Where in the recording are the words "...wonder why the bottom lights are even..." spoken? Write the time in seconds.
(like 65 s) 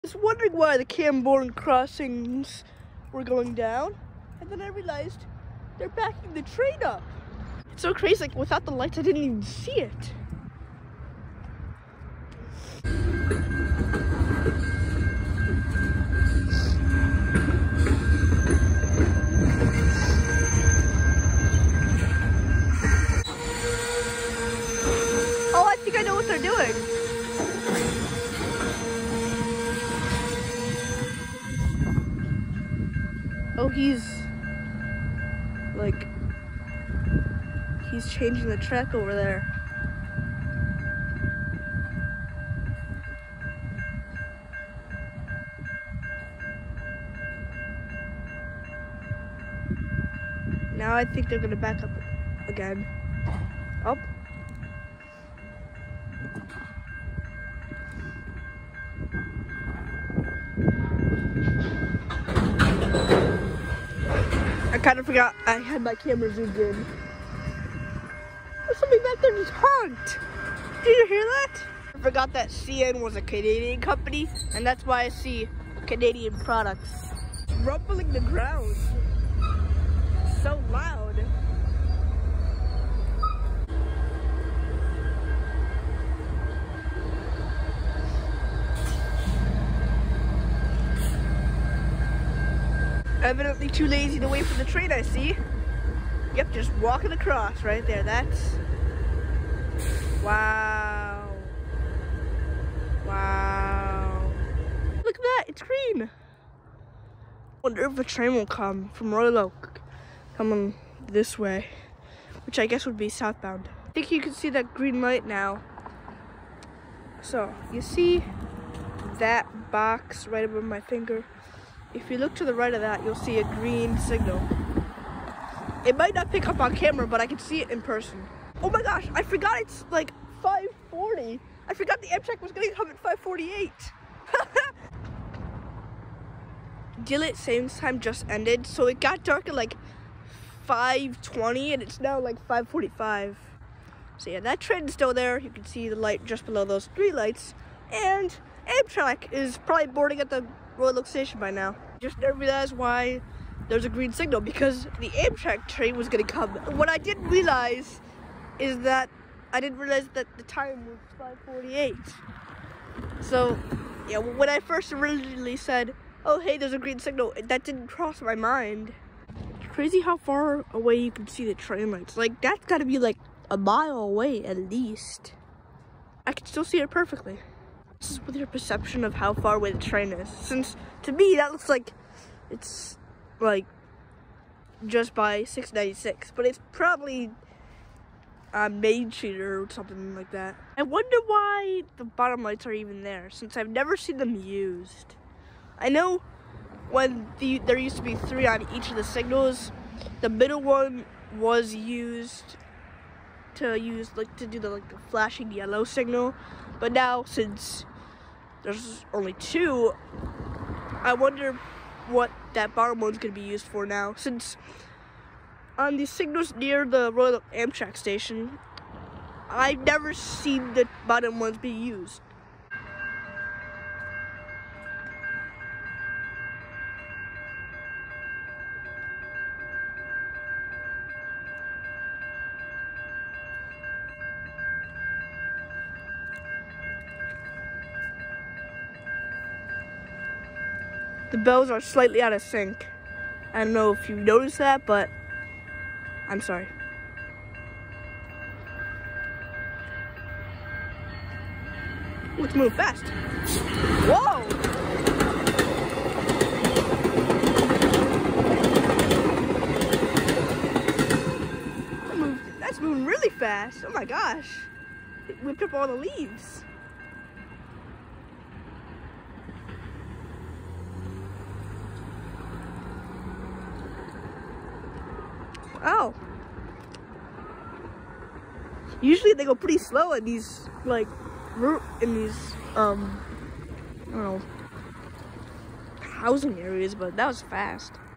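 190 s.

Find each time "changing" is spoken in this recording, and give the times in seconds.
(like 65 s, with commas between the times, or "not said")
38 s.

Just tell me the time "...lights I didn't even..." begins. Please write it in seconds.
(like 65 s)
8 s.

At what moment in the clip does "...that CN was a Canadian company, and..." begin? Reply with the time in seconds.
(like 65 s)
72 s.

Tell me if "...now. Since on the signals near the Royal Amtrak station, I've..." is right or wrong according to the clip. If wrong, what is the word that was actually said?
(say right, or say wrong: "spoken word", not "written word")
right.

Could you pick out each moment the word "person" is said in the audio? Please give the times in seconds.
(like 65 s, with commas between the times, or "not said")
127 s.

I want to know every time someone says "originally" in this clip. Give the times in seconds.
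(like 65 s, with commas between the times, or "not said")
164 s.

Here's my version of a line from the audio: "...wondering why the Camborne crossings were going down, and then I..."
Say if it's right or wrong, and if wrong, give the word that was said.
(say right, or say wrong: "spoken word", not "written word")
right.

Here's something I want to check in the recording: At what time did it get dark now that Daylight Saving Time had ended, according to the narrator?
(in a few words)
5:20.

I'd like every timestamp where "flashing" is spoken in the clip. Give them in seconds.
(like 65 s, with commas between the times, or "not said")
205 s.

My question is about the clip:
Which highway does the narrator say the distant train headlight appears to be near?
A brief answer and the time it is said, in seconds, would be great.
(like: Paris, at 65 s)
696, at 185 s.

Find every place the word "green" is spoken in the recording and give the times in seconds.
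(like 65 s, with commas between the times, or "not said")
105 s, 114 s, 123 s, 153 s, 166 s.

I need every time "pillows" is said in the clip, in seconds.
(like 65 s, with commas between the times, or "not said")
not said.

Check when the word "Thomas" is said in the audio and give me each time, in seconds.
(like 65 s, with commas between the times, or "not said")
not said.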